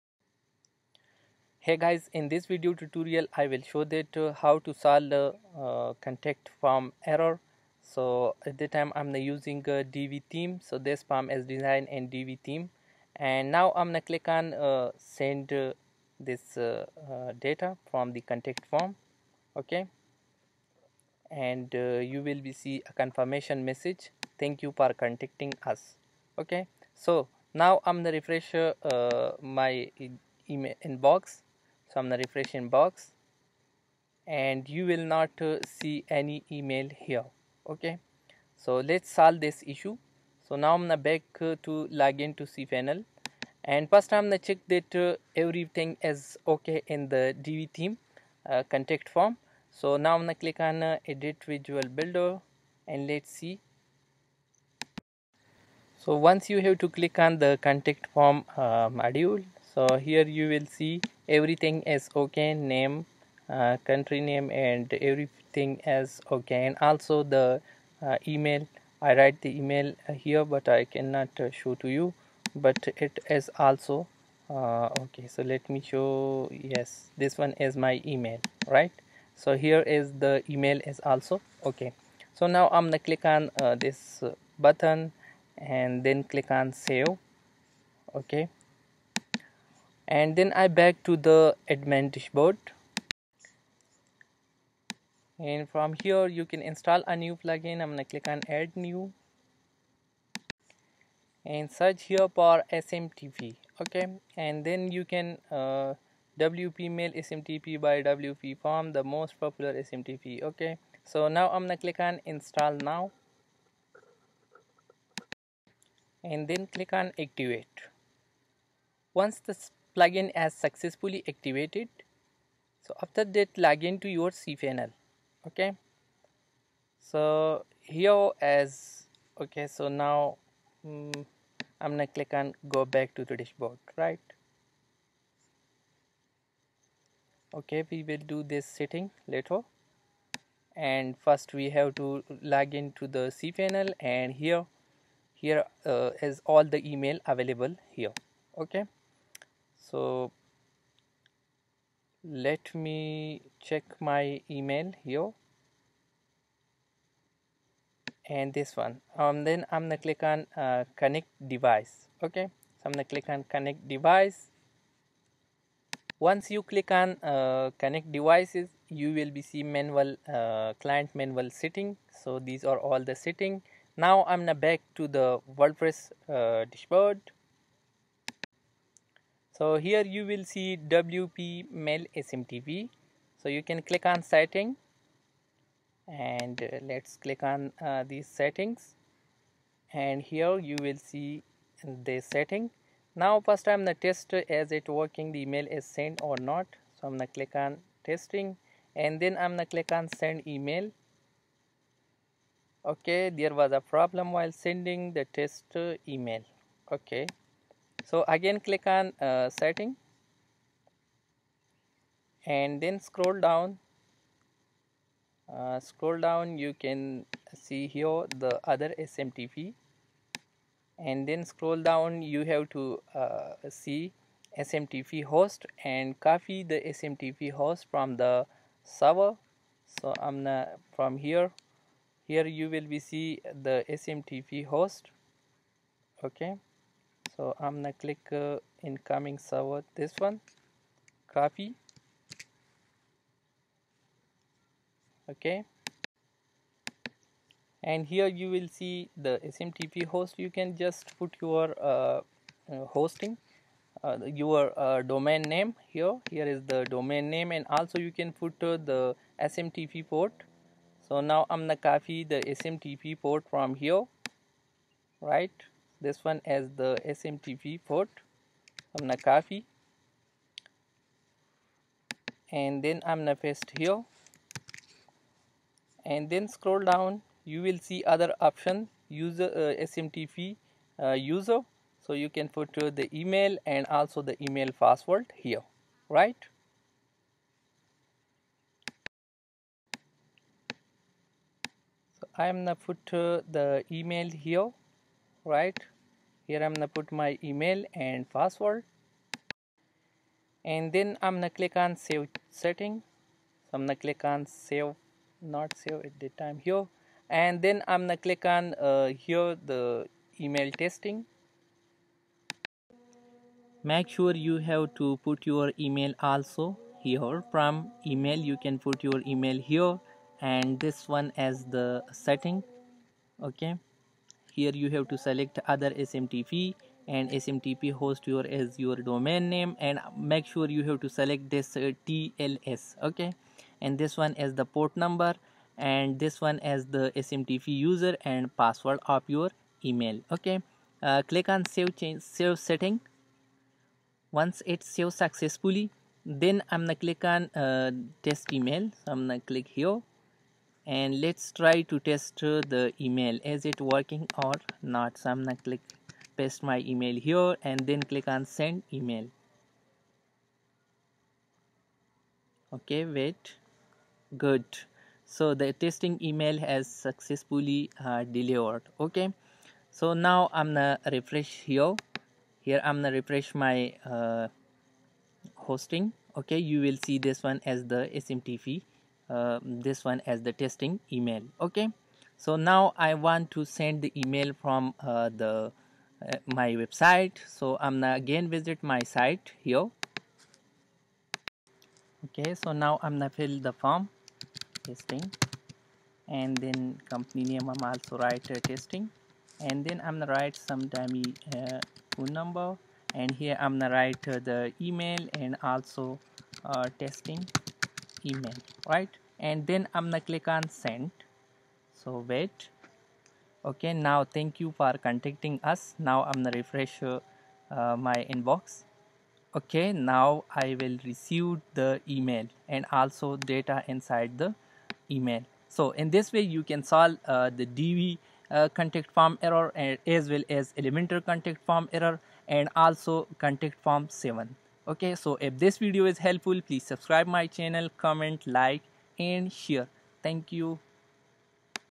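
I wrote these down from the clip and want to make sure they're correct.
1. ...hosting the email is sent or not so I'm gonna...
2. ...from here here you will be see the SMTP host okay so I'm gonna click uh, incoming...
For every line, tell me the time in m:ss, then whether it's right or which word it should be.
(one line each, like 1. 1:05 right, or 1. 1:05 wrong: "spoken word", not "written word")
1. 3:14 wrong: "working", not "hosting"
2. 3:50 right.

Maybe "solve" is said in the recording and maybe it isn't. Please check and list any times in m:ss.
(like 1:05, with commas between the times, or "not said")
0:04, 0:39, 7:06.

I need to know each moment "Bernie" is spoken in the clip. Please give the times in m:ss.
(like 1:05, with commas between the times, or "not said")
not said.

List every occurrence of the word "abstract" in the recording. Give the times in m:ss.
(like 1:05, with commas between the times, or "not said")
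not said.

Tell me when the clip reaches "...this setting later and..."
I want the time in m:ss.
2:18.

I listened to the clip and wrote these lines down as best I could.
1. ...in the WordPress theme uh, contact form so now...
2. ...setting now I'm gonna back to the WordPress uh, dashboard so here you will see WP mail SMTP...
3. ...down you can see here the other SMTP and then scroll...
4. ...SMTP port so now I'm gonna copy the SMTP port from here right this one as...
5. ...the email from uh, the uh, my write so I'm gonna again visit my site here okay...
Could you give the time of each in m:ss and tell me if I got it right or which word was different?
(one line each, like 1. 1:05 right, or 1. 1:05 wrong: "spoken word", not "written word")
1. 0:46 wrong: "Divi", not "WordPress"
2. 2:53 right
3. 3:36 right
4. 4:19 right
5. 6:24 wrong: "website", not "write".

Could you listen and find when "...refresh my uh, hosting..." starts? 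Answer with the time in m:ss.
6:13.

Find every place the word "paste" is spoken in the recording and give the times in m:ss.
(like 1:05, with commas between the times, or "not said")
4:33, 5:56.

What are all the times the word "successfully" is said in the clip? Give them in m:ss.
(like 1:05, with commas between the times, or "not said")
2:00, 5:45, 6:06.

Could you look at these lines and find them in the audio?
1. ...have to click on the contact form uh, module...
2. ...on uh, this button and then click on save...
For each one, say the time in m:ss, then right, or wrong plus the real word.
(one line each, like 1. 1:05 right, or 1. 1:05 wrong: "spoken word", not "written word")
1. 0:56 right
2. 1:23 right.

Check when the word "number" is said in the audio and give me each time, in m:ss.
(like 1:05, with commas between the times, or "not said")
5:35, 6:42.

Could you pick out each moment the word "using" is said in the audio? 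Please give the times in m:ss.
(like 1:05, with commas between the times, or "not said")
0:09.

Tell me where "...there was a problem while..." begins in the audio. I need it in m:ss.
3:23.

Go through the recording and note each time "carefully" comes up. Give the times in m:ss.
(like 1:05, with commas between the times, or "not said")
not said.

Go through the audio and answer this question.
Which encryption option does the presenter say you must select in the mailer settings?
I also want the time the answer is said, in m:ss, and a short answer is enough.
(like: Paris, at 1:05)
TLS, at 5:32.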